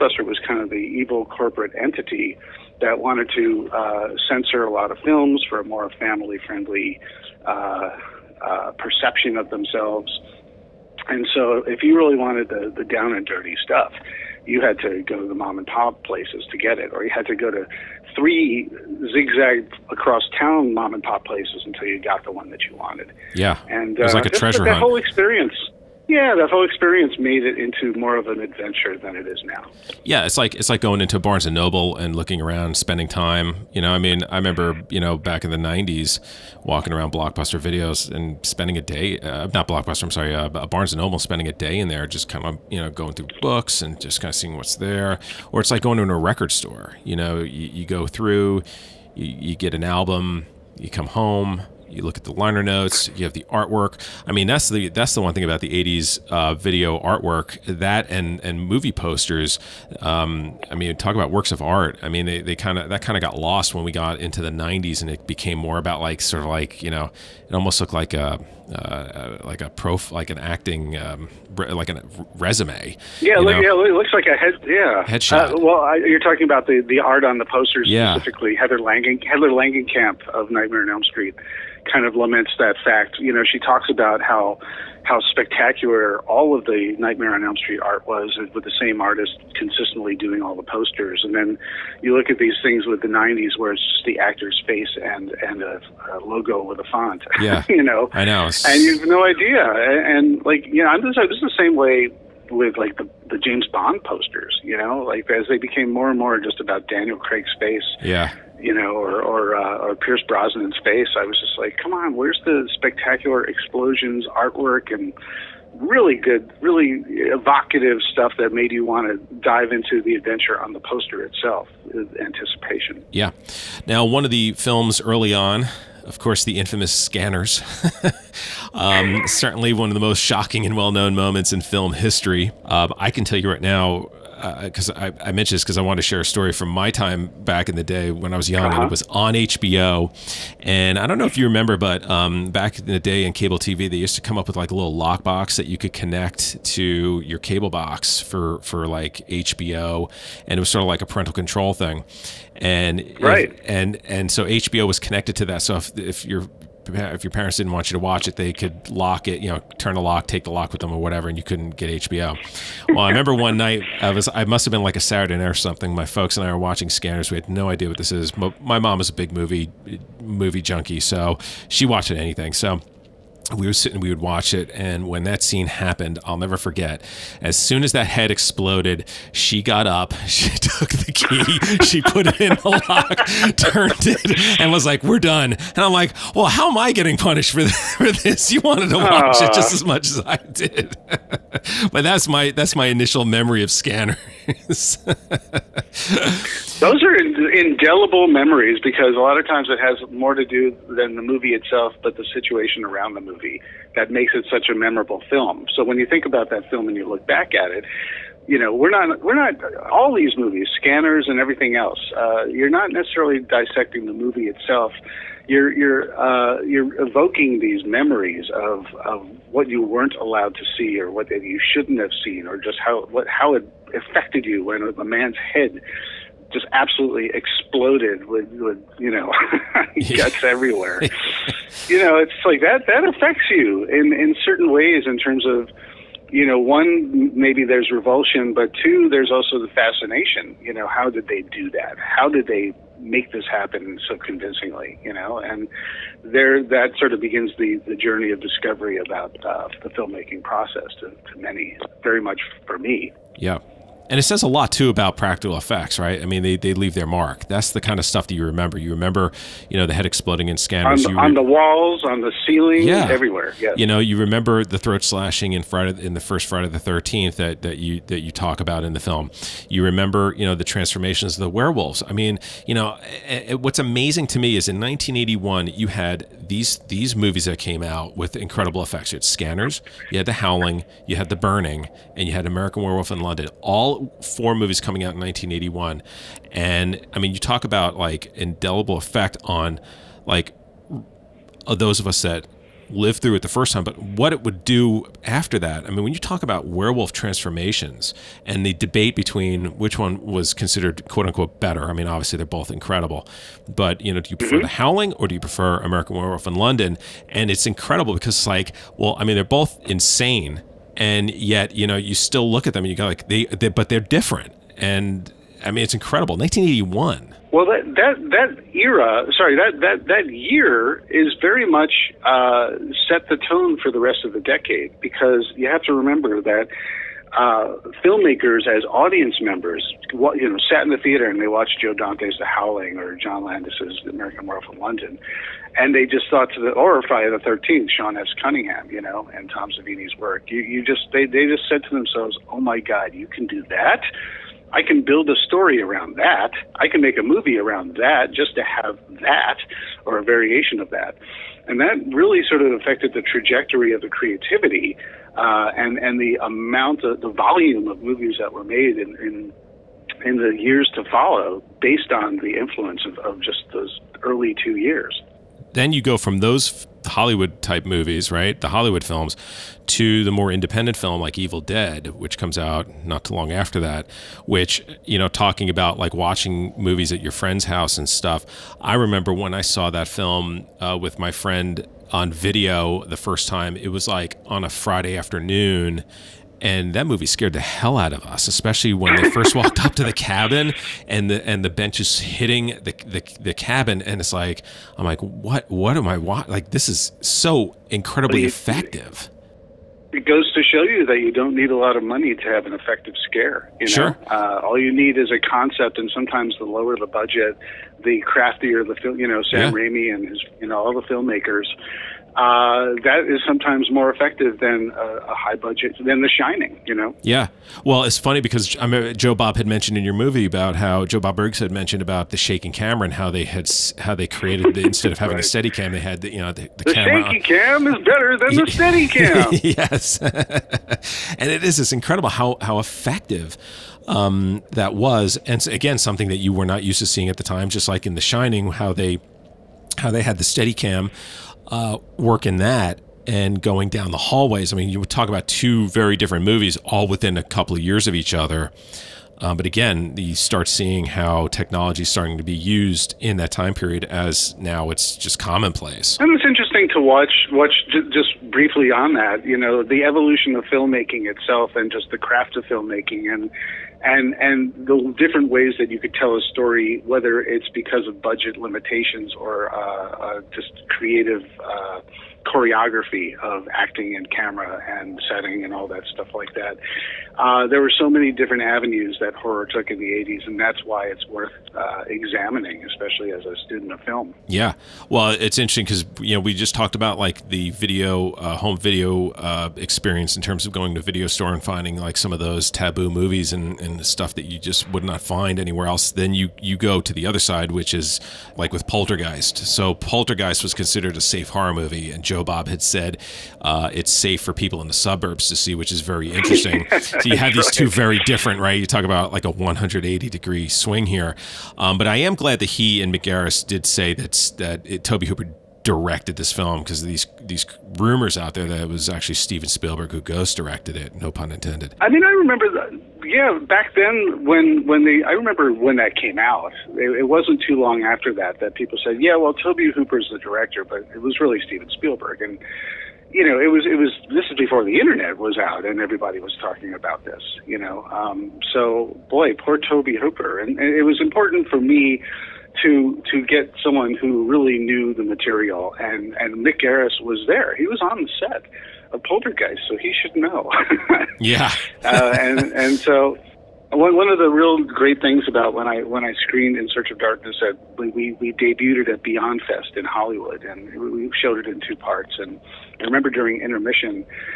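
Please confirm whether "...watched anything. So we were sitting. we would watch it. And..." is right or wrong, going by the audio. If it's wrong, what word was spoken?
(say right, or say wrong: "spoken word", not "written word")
right.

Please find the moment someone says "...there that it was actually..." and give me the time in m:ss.
8:38.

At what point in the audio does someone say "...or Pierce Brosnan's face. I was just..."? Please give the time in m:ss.
1:49.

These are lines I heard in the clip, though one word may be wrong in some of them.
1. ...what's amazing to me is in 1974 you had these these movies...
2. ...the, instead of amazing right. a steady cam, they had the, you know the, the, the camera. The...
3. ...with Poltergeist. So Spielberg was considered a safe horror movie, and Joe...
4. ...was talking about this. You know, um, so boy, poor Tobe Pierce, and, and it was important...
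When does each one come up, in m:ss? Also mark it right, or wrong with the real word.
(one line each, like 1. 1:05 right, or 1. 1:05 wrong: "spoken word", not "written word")
1. 4:33 wrong: "1981", not "1974"
2. 7:04 wrong: "having", not "amazing"
3. 8:18 wrong: "Poltergeist", not "Spielberg"
4. 8:56 wrong: "Hooper", not "Pierce".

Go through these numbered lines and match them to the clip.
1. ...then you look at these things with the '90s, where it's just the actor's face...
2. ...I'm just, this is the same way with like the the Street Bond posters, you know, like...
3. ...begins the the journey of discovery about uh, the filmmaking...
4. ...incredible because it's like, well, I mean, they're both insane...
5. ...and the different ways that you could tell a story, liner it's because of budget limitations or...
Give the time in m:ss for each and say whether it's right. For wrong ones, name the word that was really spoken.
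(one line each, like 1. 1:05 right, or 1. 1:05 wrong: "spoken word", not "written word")
1. 1:31 right
2. 1:40 wrong: "James", not "Street"
3. 4:07 right
4. 5:07 right
5. 7:44 wrong: "whether", not "liner".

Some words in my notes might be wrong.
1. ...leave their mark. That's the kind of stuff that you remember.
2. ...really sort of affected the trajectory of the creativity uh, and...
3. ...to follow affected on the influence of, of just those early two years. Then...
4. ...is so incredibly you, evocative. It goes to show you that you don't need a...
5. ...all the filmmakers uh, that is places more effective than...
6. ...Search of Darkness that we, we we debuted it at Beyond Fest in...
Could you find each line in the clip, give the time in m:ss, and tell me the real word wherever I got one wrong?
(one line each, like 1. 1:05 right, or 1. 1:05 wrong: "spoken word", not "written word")
1. 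4:16 right
2. 5:52 right
3. 6:00 wrong: "based", not "affected"
4. 6:36 wrong: "effective", not "evocative"
5. 6:50 wrong: "sometimes", not "places"
6. 9:16 right.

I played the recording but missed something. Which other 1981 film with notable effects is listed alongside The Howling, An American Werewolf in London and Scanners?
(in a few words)
The Burning.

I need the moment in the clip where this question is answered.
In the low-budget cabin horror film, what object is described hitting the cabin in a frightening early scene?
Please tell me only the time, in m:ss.
6:31.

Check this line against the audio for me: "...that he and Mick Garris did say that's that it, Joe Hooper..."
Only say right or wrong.
wrong.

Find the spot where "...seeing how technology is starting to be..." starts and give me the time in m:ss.
7:30.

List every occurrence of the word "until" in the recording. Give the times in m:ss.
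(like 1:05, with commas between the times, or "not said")
0:21.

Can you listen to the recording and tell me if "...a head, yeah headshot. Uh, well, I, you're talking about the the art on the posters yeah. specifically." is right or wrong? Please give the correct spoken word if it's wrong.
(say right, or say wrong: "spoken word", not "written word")
right.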